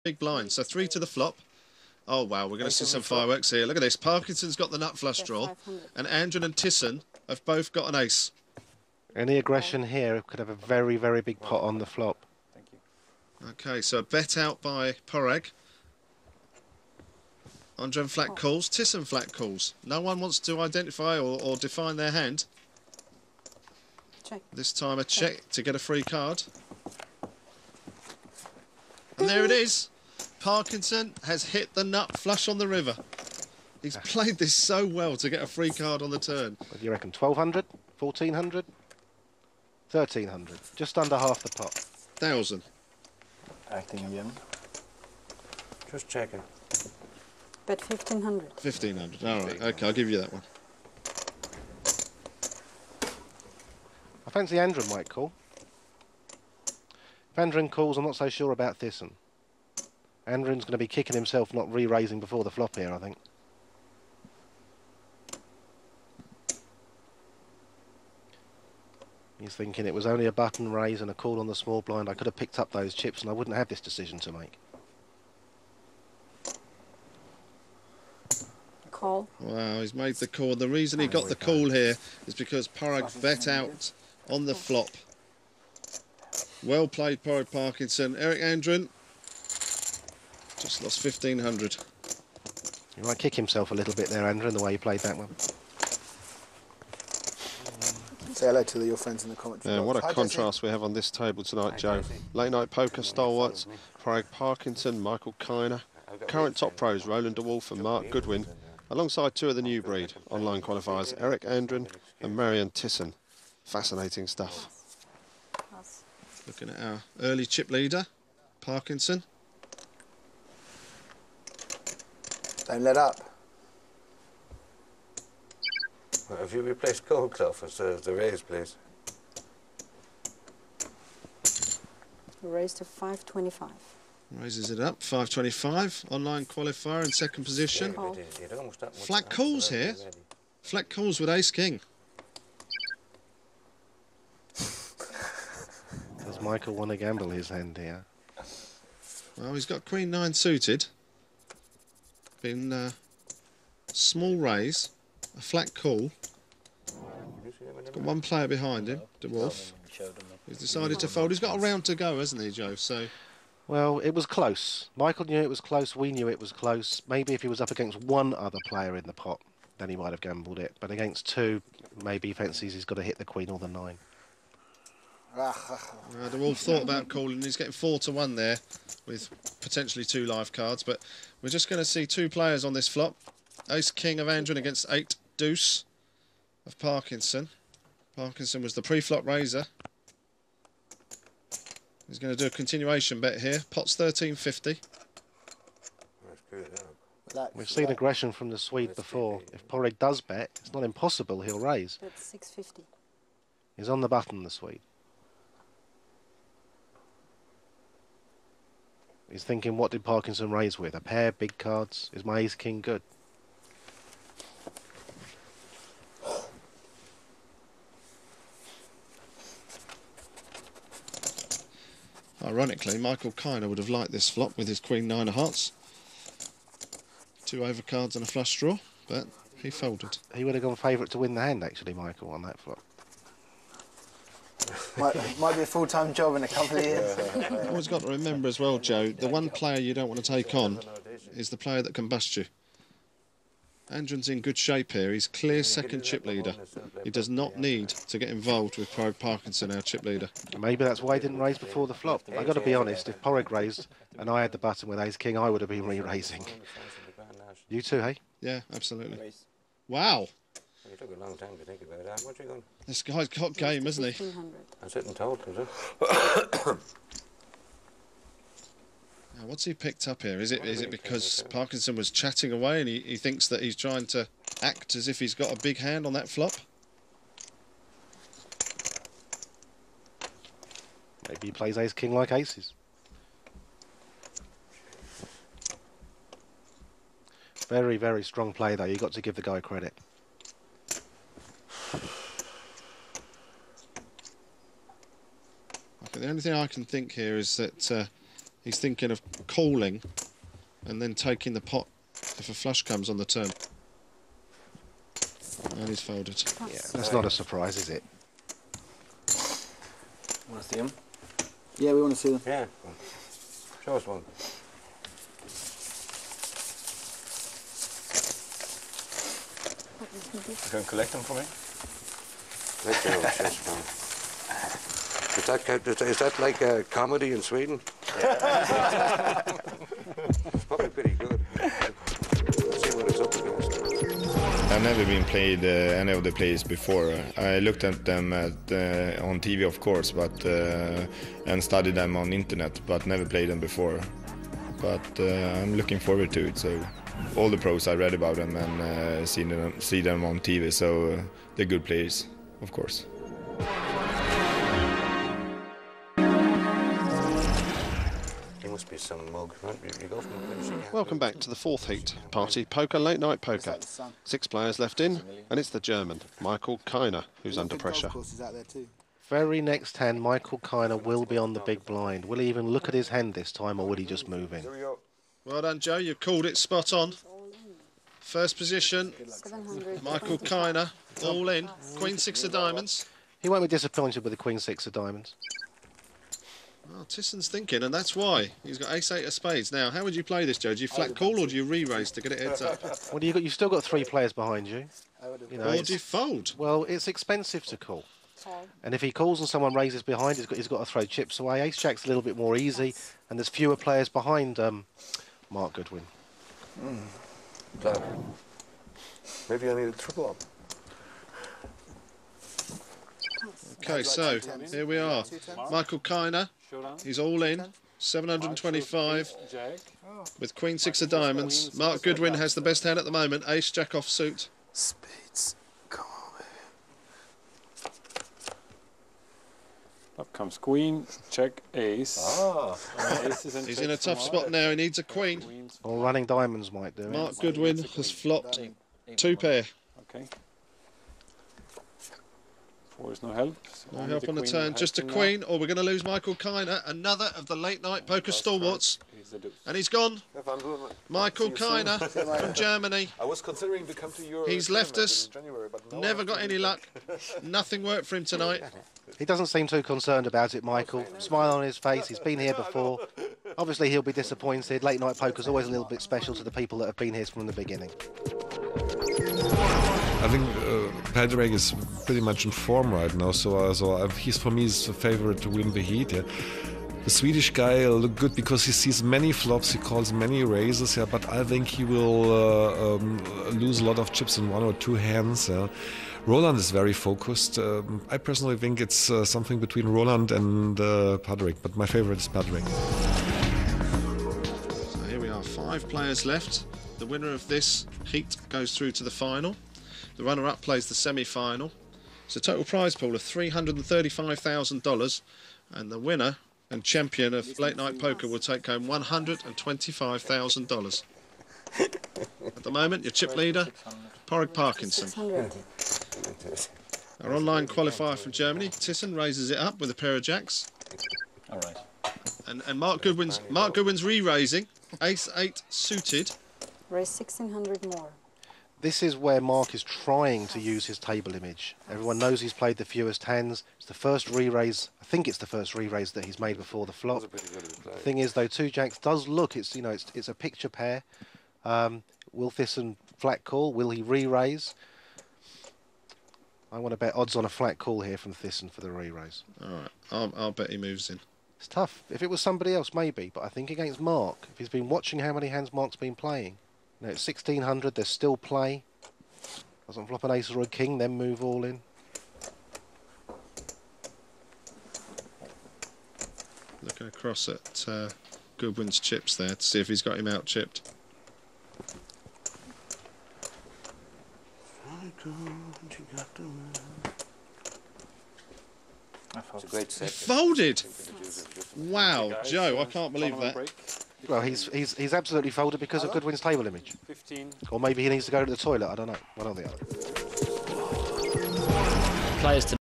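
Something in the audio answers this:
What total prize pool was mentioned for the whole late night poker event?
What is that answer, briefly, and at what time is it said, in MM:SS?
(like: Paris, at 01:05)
$335,000, at 08:23.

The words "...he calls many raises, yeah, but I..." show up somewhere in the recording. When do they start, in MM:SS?
07:59.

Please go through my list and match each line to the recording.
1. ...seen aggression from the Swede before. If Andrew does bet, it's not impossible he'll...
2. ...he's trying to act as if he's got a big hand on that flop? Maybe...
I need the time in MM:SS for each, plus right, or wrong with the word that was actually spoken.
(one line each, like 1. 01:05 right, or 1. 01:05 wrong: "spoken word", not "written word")
1. 03:17 wrong: "Padraig", not "Andrew"
2. 04:33 right.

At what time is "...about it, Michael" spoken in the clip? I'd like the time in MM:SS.
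07:40.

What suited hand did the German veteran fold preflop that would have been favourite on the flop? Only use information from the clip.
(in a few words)
Queen nine suited.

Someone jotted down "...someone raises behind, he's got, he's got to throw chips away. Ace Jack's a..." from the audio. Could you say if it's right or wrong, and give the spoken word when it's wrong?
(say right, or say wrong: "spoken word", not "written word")
right.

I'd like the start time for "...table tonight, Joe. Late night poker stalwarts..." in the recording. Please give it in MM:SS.
01:41.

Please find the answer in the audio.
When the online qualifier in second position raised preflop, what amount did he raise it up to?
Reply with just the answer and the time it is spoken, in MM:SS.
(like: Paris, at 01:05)
525, at 02:12.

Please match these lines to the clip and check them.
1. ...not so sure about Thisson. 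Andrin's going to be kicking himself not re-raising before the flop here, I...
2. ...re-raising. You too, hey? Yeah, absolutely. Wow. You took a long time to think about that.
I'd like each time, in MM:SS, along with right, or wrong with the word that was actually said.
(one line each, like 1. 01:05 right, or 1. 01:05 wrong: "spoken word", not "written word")
1. 00:58 right
2. 04:15 right.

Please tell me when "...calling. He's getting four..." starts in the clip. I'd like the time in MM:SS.
02:57.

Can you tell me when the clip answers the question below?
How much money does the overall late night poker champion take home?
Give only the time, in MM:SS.
08:28.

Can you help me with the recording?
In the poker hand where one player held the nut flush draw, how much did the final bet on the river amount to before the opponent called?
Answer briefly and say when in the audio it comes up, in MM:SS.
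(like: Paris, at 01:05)
1500, at 00:47.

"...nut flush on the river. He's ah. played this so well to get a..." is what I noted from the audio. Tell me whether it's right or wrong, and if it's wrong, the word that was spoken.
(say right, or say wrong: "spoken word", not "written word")
right.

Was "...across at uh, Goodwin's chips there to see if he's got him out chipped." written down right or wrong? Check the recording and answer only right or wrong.
right.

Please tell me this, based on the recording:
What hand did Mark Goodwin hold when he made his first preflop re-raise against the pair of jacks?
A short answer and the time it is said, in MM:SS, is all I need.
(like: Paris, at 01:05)
Ace eight suited, at 08:45.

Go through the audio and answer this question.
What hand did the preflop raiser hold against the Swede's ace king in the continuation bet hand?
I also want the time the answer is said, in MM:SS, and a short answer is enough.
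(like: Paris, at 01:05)
Eight deuce, at 03:04.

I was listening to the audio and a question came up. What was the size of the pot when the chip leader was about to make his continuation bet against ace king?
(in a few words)
13.50.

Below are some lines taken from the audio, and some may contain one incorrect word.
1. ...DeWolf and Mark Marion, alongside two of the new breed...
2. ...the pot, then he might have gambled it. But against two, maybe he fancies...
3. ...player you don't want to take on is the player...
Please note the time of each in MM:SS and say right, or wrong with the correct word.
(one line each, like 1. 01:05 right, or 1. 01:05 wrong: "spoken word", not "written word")
1. 01:47 wrong: "Goodwin", not "Marion"
2. 02:49 right
3. 03:59 right.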